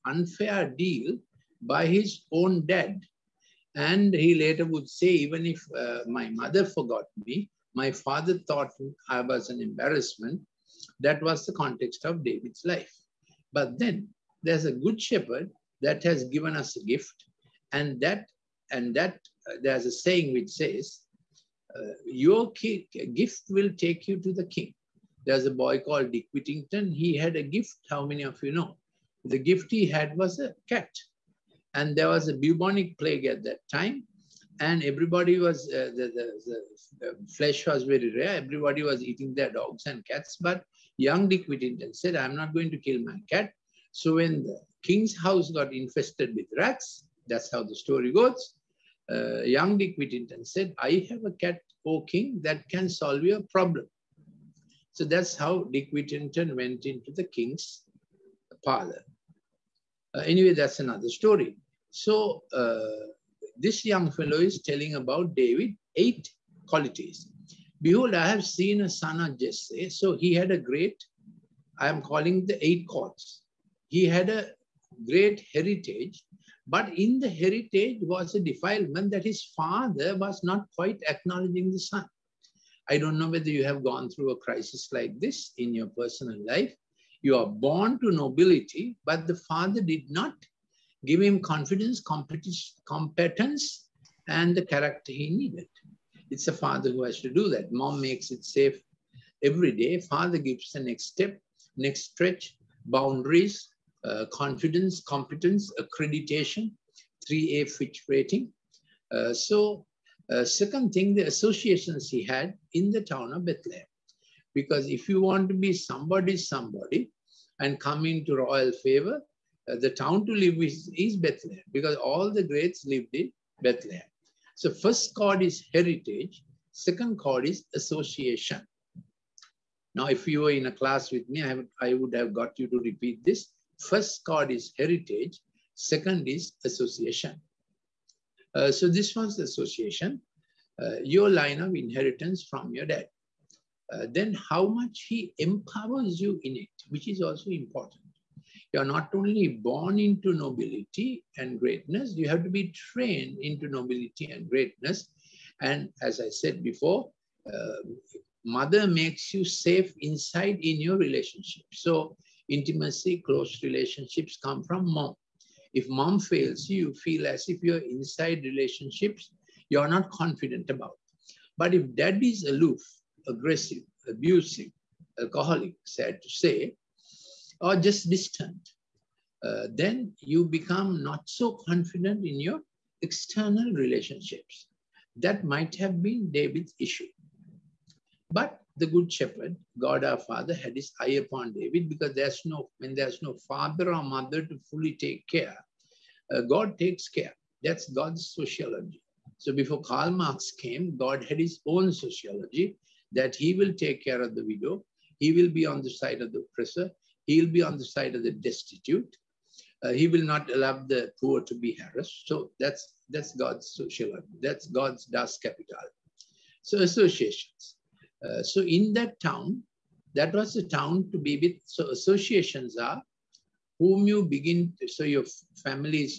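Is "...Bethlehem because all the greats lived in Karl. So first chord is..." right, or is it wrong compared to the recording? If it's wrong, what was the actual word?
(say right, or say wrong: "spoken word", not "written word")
wrong: "Bethlehem", not "Karl".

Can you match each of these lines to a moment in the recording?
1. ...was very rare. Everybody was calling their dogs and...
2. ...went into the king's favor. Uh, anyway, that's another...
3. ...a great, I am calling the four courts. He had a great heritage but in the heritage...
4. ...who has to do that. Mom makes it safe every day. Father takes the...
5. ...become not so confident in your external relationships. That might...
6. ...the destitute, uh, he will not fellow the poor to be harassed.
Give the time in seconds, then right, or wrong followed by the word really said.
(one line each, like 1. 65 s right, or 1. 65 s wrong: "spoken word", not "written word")
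1. 37 s wrong: "eating", not "calling"
2. 56 s wrong: "parlor", not "favor"
3. 70 s wrong: "eight", not "four"
4. 96 s wrong: "gives", not "takes"
5. 180 s right
6. 208 s wrong: "allow", not "fellow".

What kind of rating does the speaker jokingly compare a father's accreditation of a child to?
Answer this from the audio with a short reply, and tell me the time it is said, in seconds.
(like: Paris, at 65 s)
3A Fitch rating, at 107 s.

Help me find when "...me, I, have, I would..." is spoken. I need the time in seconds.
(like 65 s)
131 s.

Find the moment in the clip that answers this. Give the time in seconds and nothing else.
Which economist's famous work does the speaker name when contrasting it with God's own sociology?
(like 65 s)
199 s.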